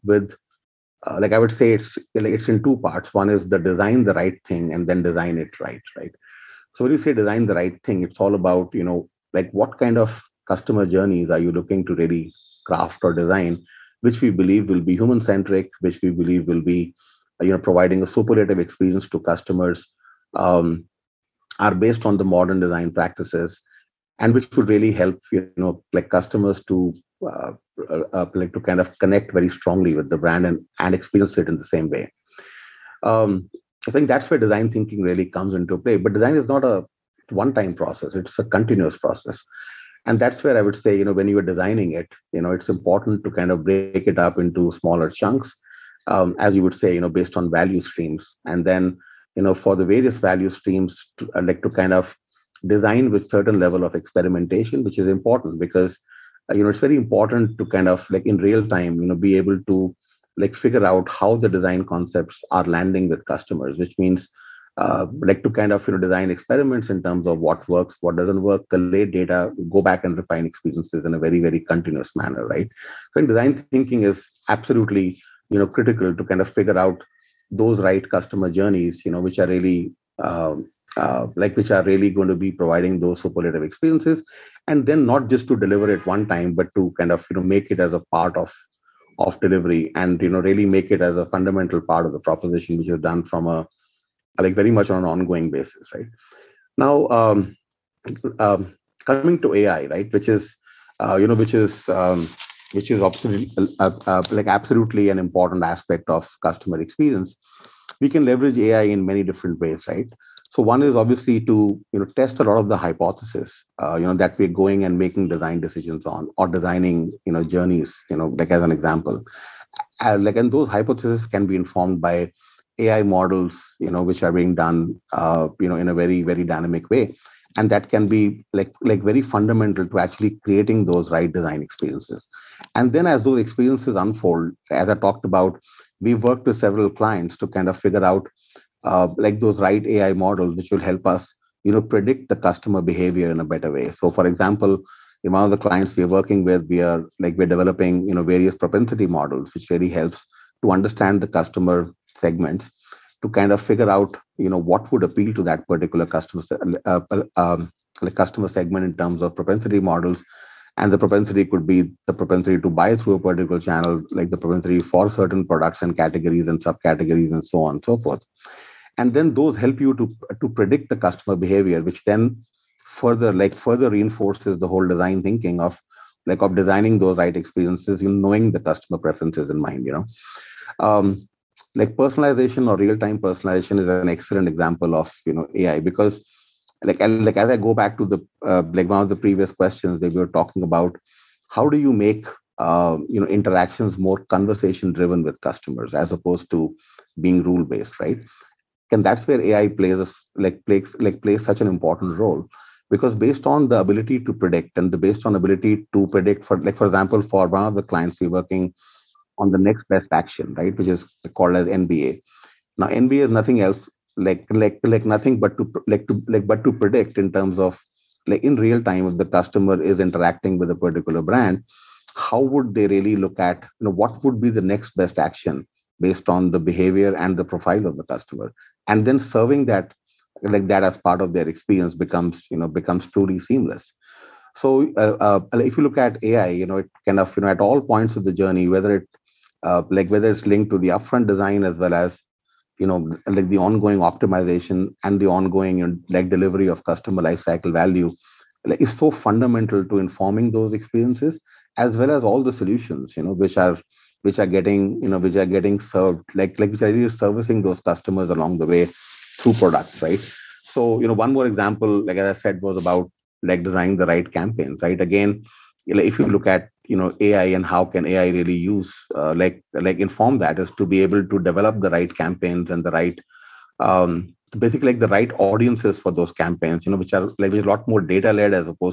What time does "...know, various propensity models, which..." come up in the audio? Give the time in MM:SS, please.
02:28.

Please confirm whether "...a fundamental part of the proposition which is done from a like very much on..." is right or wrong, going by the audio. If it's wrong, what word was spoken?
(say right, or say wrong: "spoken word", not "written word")
right.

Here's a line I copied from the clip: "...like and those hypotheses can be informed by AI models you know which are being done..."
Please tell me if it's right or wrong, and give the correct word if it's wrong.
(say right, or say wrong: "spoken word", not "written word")
right.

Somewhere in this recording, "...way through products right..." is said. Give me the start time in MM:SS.
04:18.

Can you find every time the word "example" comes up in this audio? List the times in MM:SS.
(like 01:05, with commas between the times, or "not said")
01:58, 02:24, 03:04, 03:26, 04:21.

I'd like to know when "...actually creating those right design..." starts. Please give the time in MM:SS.
02:09.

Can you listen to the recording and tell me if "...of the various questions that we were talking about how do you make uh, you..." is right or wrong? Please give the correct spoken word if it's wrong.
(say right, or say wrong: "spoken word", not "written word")
wrong: "previous", not "various".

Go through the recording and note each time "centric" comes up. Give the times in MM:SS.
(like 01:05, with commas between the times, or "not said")
00:15.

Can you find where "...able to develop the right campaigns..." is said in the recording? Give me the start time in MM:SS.
04:31.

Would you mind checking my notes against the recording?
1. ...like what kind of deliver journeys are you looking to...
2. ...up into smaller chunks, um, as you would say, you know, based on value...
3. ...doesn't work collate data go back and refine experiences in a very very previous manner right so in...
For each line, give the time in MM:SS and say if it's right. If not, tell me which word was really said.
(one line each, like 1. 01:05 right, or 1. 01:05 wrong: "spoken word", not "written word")
1. 00:09 wrong: "customer", not "deliver"
2. 00:44 right
3. 01:08 wrong: "continuous", not "previous".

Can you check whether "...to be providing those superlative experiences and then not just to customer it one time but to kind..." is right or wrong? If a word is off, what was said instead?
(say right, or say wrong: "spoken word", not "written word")
wrong: "deliver", not "customer".